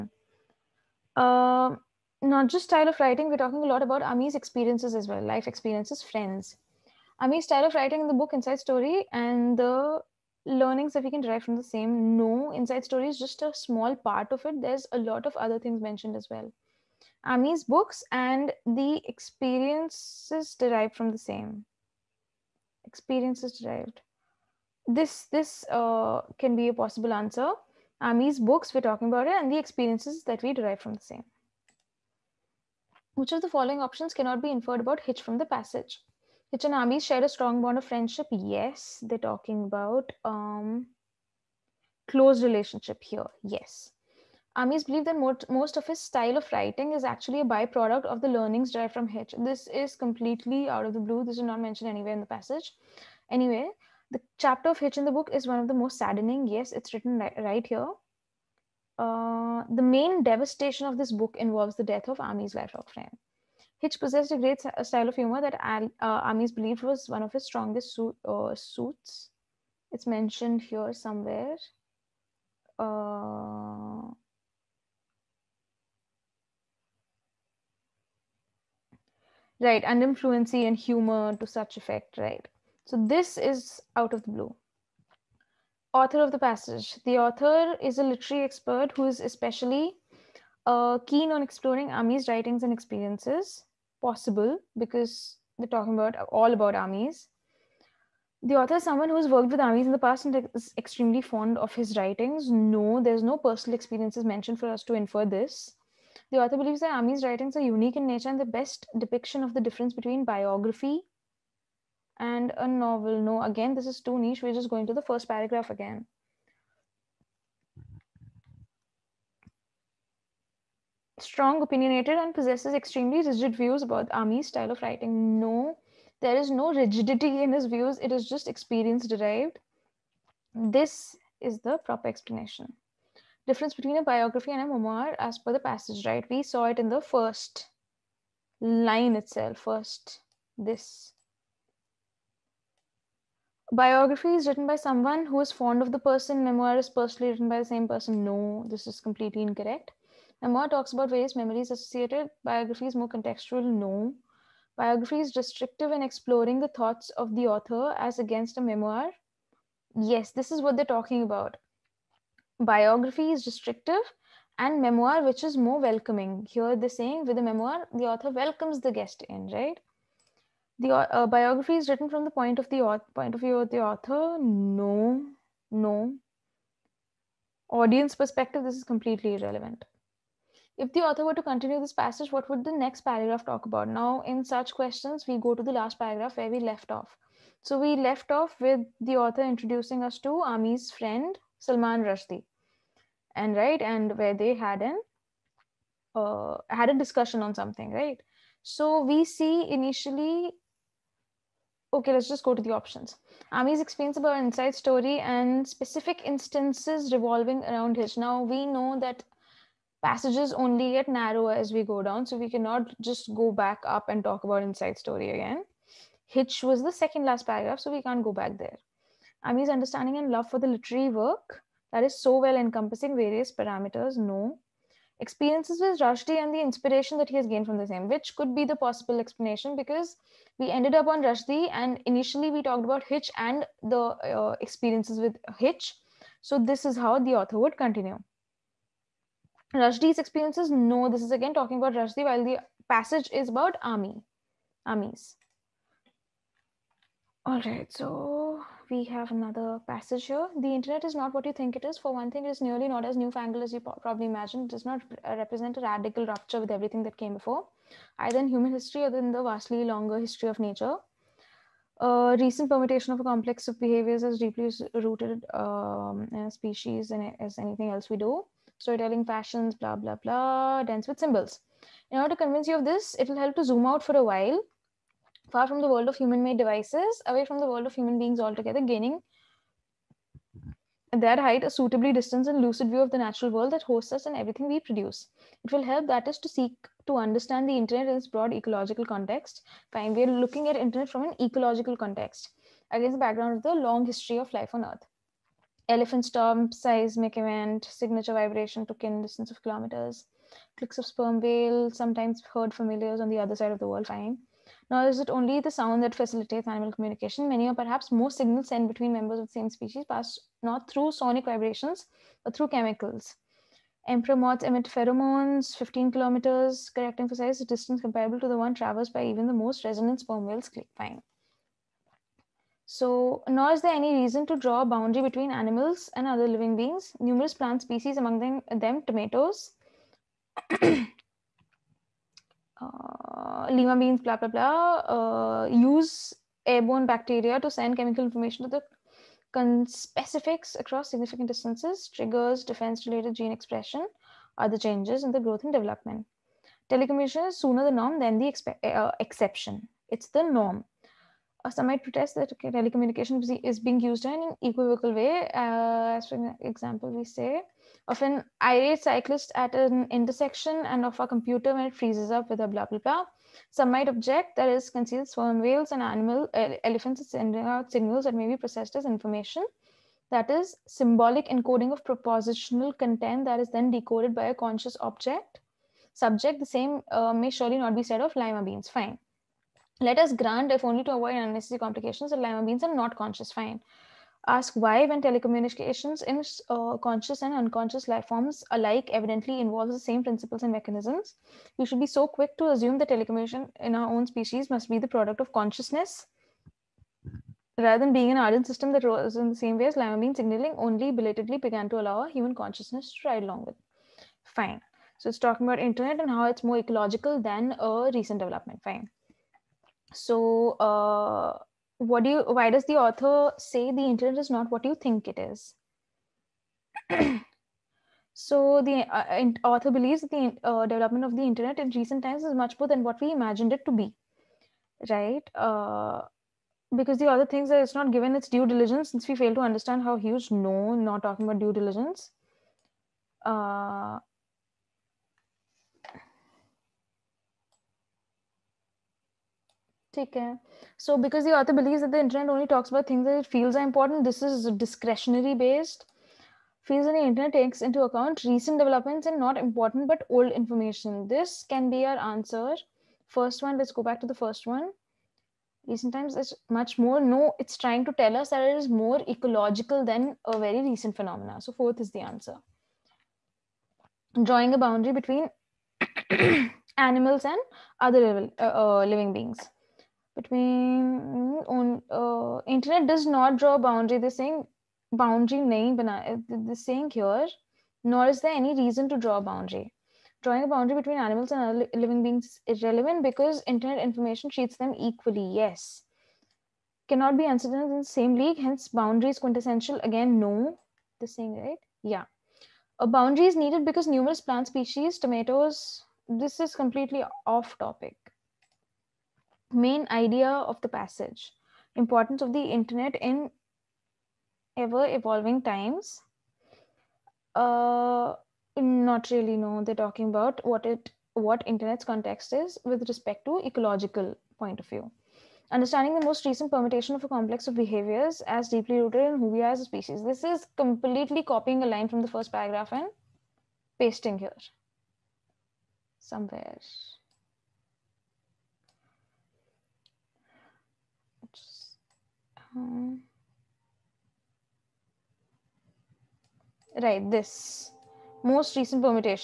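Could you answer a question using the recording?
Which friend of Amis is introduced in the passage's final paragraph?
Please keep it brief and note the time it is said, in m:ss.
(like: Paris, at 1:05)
Salman Rushdie, at 3:11.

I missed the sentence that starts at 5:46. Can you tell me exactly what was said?
Telecommunication is sooner the norm than the uh, exception.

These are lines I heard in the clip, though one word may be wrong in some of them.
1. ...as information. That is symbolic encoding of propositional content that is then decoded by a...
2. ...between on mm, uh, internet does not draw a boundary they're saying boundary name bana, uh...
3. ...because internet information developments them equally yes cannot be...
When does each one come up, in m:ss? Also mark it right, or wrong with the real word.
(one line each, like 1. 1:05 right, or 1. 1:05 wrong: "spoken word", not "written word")
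1. 6:08 right
2. 7:50 right
3. 8:03 wrong: "treats", not "developments".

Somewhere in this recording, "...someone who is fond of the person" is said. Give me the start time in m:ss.
2:24.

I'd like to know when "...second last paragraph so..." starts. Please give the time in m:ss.
3:36.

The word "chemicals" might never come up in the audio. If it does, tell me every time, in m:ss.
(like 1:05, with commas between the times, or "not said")
5:12, 5:37.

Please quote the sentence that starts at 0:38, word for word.
Yes, they're talking about um, close relationship here.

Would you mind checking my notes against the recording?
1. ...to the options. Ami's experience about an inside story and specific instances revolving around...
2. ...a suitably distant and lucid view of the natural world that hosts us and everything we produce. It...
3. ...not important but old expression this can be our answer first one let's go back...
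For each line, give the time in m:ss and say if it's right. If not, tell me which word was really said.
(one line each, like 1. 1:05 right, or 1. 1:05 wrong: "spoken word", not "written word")
1. 3:22 right
2. 4:41 right
3. 7:29 wrong: "information", not "expression".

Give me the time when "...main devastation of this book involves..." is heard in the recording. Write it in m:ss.
0:59.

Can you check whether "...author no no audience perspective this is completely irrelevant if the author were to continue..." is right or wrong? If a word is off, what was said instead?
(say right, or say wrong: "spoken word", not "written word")
right.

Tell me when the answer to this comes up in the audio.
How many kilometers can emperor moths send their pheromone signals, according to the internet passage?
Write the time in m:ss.
5:15.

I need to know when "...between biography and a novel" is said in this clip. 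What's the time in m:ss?
1:49.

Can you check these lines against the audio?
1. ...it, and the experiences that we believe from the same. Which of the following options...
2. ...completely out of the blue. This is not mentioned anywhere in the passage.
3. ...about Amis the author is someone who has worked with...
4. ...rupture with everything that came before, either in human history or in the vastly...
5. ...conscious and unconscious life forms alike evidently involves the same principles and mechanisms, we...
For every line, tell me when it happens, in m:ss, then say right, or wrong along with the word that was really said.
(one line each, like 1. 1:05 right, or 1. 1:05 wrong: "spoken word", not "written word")
1. 0:29 wrong: "derive", not "believe"
2. 0:49 right
3. 1:36 right
4. 4:16 right
5. 6:26 right.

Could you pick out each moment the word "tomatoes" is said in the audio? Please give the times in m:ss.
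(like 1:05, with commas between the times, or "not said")
5:29, 8:15.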